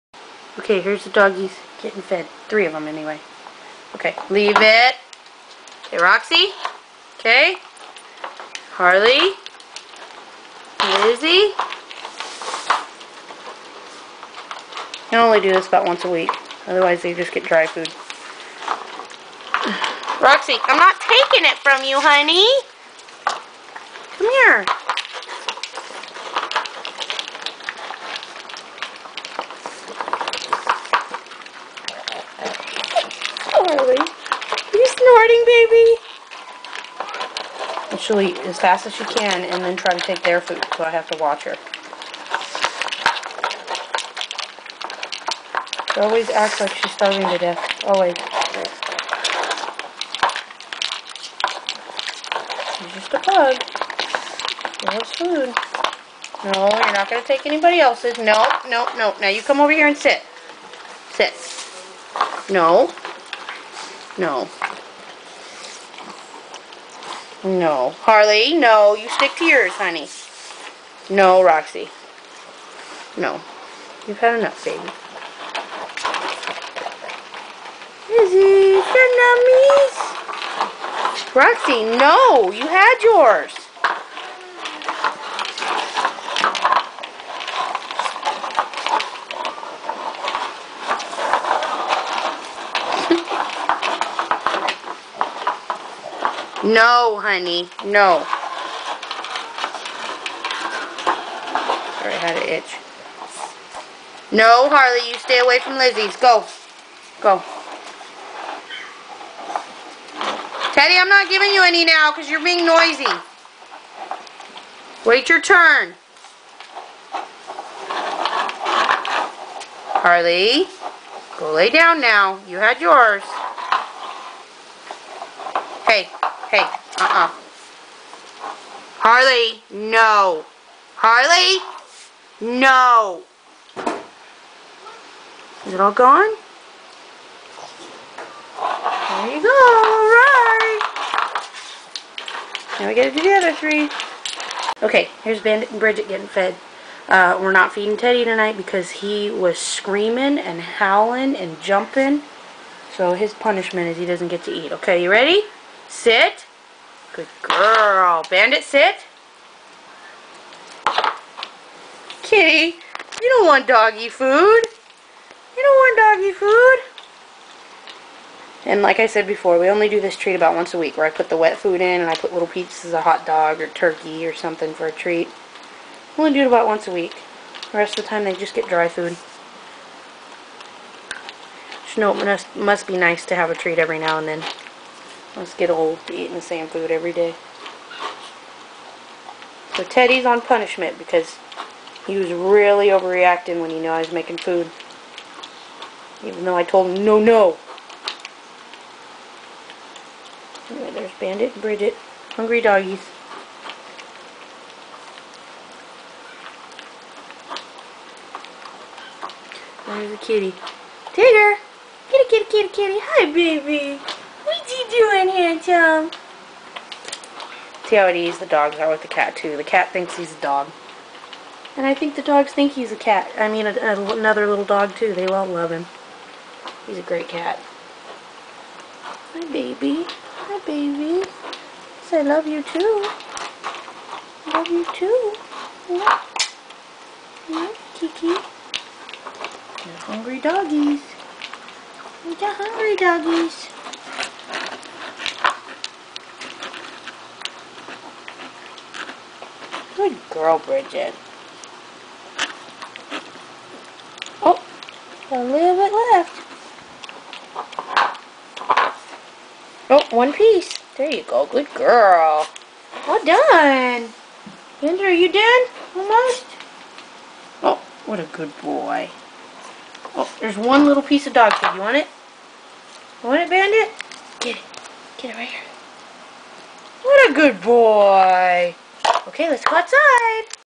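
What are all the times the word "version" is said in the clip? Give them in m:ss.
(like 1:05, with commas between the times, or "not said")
not said.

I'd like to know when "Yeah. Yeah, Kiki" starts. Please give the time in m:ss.
3:55.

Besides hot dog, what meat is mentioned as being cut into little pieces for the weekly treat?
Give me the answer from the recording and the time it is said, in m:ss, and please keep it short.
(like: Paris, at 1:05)
turkey, at 2:53.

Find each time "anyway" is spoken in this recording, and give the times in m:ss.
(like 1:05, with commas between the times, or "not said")
0:02, 3:20.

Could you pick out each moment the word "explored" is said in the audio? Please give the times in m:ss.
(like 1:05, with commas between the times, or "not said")
not said.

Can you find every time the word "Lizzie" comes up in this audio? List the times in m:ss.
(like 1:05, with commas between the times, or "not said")
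0:11, 1:45.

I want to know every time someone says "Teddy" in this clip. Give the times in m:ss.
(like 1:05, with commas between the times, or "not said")
1:50, 2:27, 3:09.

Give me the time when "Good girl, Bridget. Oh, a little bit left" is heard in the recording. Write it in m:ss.
4:10.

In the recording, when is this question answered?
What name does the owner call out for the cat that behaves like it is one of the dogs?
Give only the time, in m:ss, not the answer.
3:31.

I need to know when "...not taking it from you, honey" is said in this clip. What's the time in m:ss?
0:20.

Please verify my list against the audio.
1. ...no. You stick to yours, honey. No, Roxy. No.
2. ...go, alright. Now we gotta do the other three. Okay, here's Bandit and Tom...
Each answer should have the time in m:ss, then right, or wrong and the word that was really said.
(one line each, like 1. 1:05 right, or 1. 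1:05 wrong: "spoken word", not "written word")
1. 1:08 right
2. 2:19 wrong: "Bridget", not "Tom".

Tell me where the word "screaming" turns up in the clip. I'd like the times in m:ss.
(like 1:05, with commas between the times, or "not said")
2:29.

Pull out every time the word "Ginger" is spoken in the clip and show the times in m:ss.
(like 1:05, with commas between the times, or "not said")
4:24.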